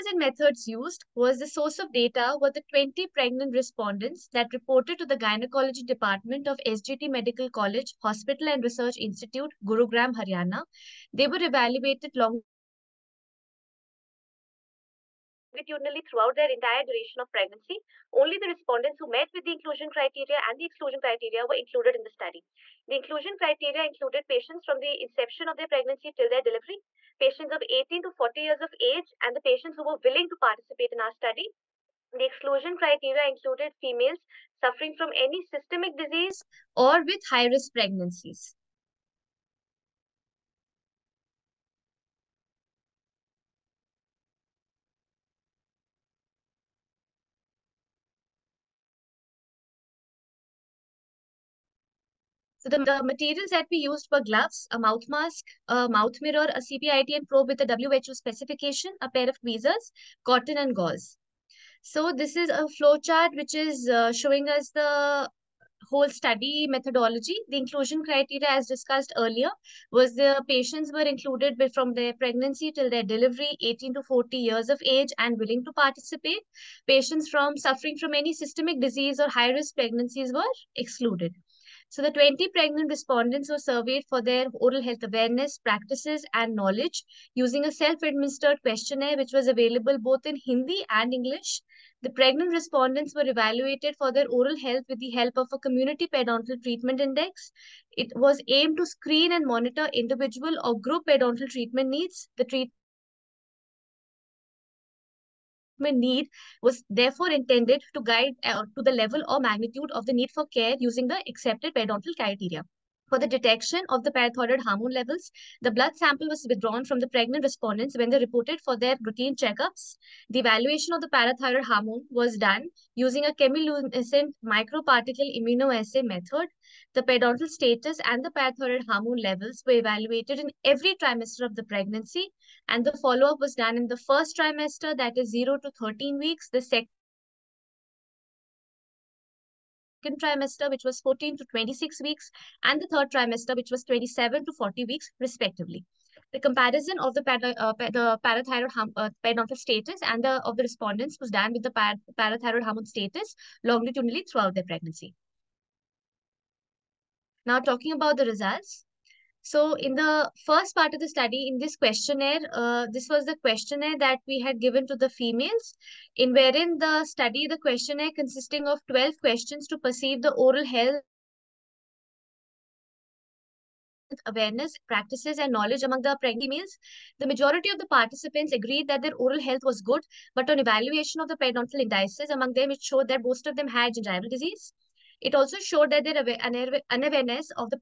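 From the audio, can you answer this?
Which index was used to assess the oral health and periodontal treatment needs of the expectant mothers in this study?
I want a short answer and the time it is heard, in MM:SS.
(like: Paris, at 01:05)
community periodontal treatment index, at 01:35.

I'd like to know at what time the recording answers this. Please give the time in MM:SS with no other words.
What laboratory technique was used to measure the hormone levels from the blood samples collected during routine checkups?
02:03.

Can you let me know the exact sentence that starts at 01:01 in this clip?
So this is a flow chart which is uh, showing us the whole study methodology.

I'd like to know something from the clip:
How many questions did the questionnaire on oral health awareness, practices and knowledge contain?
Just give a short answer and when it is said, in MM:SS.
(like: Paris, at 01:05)
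12, at 02:48.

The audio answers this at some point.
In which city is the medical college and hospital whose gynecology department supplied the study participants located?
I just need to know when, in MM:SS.
00:09.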